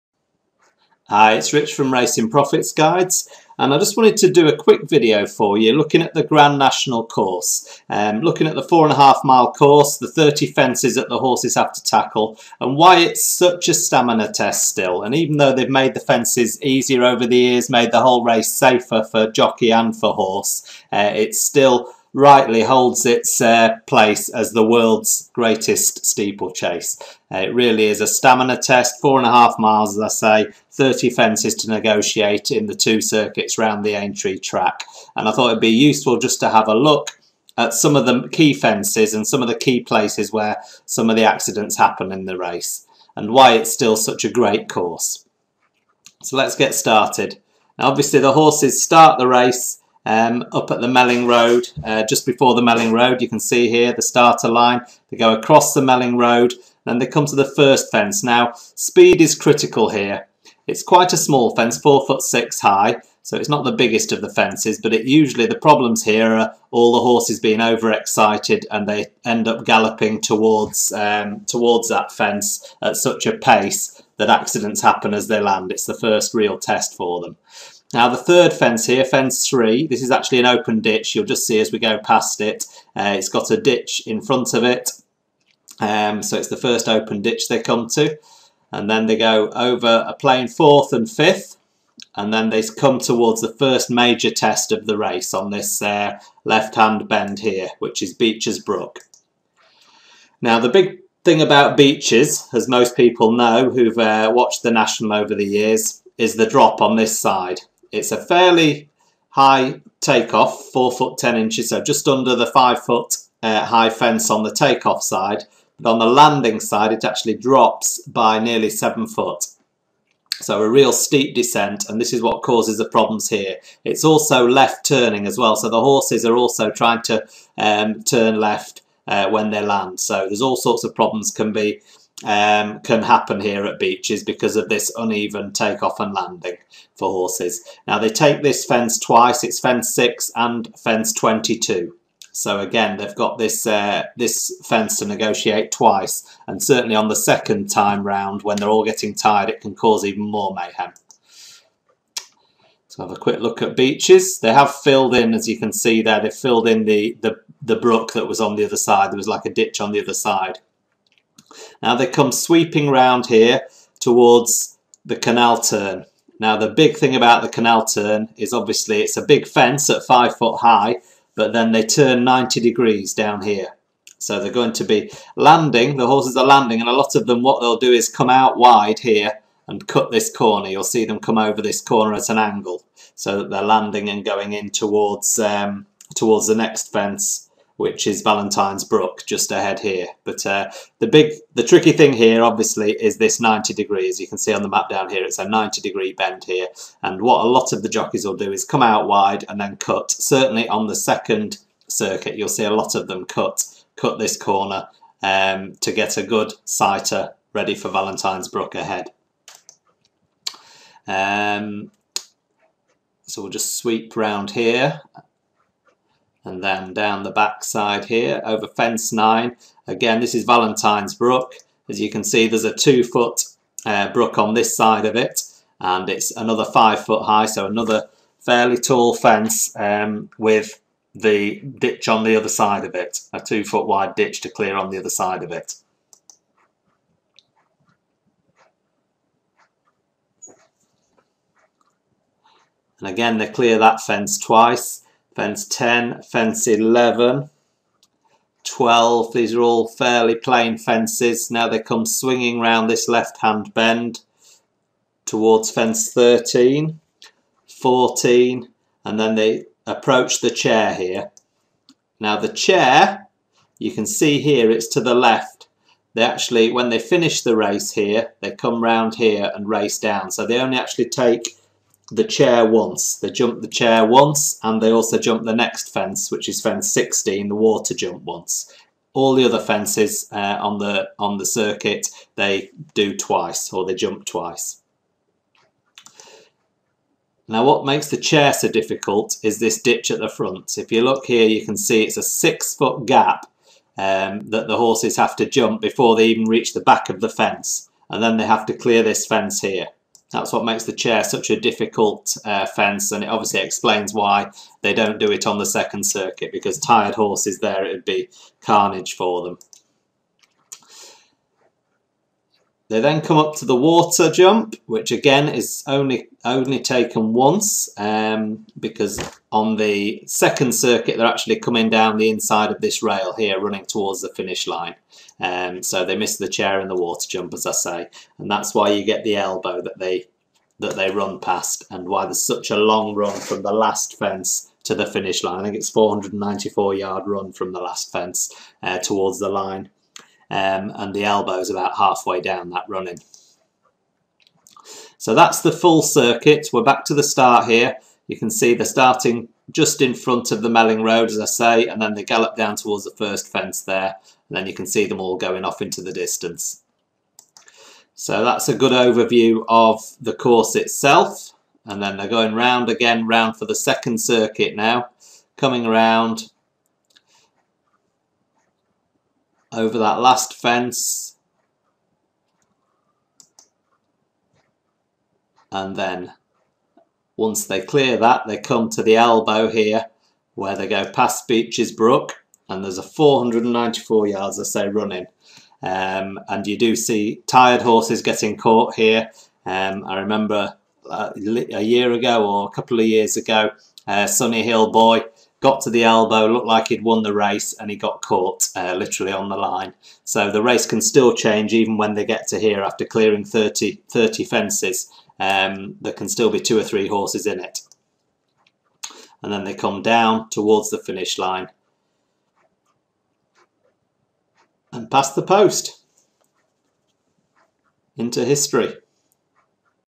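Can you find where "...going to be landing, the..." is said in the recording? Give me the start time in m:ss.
2:54.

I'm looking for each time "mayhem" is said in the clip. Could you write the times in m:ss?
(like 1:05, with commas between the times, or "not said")
2:30.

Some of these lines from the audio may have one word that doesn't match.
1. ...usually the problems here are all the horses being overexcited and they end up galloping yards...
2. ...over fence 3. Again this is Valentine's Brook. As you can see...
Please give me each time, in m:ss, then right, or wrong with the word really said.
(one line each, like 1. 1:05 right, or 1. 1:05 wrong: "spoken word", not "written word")
1. 1:05 wrong: "towards", not "yards"
2. 3:38 wrong: "9", not "3".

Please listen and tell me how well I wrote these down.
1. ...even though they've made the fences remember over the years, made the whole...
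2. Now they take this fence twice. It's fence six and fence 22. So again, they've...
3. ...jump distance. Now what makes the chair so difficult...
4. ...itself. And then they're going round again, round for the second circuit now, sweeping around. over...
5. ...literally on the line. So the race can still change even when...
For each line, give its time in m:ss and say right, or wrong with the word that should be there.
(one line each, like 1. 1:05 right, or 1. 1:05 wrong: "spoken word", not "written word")
1. 0:15 wrong: "easier", not "remember"
2. 2:17 right
3. 4:43 wrong: "twice", not "distance"
4. 6:00 wrong: "coming", not "sweeping"
5. 6:38 right.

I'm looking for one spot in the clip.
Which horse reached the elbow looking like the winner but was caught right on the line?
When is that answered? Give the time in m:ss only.
6:34.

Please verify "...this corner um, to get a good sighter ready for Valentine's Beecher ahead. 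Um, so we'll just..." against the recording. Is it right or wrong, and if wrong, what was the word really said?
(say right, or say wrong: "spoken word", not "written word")
wrong: "Brook", not "Beecher".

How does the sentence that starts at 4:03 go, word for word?
And again, they clear that fence twice.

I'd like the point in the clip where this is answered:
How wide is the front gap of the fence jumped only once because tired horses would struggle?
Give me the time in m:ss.
4:52.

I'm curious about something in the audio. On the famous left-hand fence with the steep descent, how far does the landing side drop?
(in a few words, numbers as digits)
nearly 7 foot.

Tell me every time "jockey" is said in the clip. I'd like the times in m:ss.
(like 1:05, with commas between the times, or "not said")
0:19, 3:17.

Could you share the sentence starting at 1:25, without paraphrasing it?
Um, so it's the first open ditch they come to.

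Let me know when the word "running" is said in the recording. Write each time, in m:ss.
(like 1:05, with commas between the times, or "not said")
5:23, 5:42, 6:24.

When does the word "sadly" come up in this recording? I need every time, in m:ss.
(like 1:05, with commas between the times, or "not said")
not said.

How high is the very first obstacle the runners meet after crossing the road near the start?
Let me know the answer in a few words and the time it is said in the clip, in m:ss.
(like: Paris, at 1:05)
4 foot 6, at 1:01.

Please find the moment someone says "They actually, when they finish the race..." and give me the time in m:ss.
4:26.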